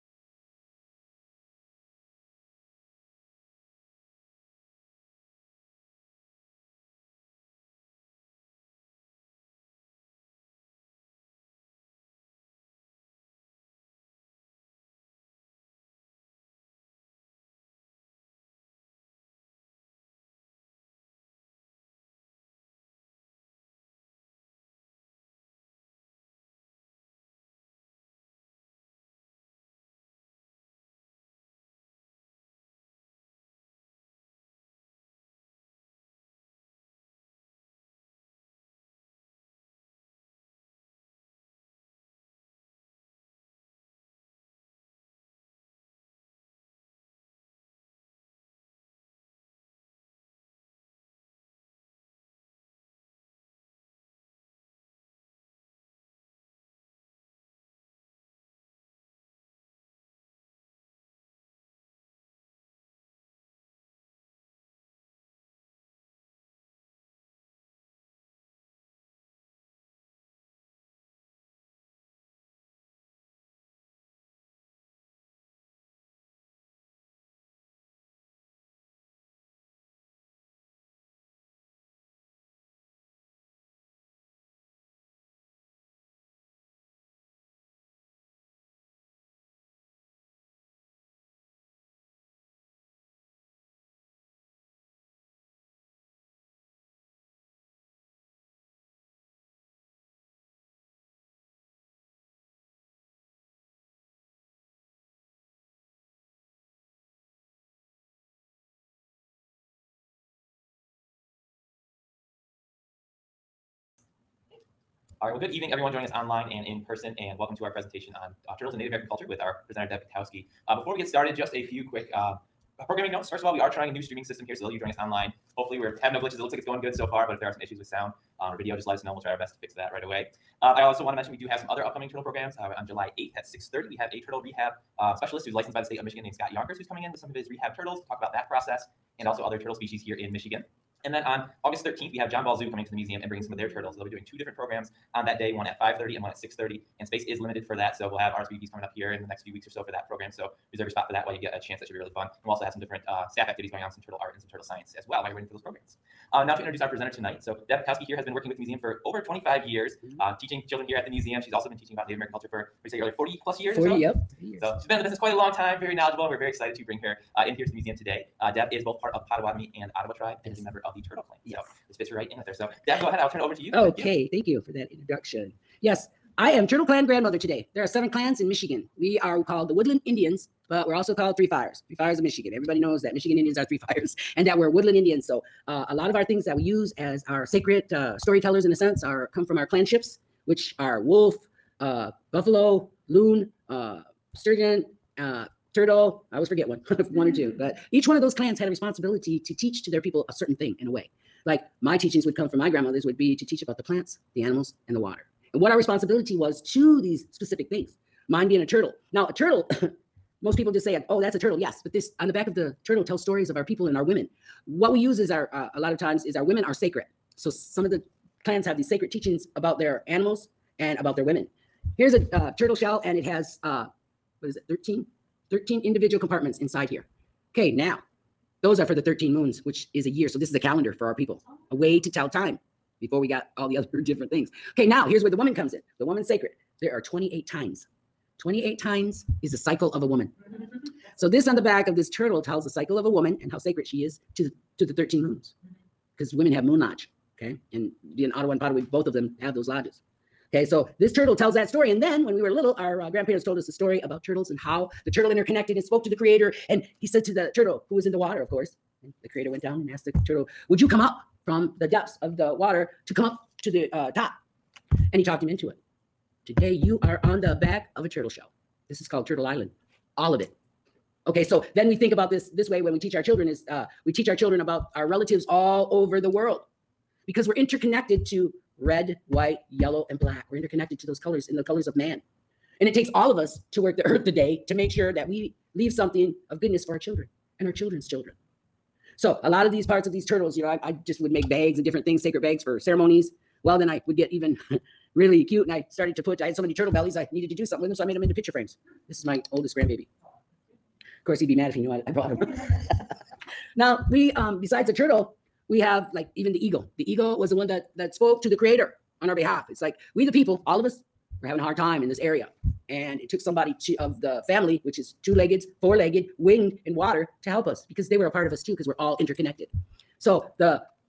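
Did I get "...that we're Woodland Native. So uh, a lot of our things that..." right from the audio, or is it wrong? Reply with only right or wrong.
wrong.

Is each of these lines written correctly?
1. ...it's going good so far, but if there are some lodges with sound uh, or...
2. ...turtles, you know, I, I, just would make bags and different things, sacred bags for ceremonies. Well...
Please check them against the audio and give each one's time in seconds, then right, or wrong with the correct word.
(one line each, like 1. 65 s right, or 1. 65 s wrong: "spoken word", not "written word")
1. 126 s wrong: "issues", not "lodges"
2. 290 s right.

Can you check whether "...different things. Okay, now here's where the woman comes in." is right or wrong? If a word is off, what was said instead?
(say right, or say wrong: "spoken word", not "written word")
right.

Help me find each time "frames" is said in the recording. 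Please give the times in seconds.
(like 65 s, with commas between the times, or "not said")
298 s.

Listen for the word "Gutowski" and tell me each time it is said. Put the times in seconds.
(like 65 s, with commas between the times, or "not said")
120 s, 157 s.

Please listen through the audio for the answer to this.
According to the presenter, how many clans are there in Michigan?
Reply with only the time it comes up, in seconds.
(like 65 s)
177 s.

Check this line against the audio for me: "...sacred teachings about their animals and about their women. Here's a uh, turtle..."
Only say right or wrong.
right.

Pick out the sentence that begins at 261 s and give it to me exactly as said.
from the depths of the water to come up to the uh, top.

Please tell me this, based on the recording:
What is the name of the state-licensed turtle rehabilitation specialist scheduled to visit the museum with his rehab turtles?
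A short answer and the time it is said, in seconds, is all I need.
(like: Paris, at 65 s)
Scott Yonkers, at 136 s.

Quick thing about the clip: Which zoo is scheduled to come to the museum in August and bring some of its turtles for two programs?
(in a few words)
John Ball Zoo.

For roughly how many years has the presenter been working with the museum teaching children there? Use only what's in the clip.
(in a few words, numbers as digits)
25.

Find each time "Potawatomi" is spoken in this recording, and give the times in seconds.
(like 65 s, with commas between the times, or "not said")
169 s, 248 s.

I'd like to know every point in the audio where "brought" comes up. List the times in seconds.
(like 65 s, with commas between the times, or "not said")
302 s.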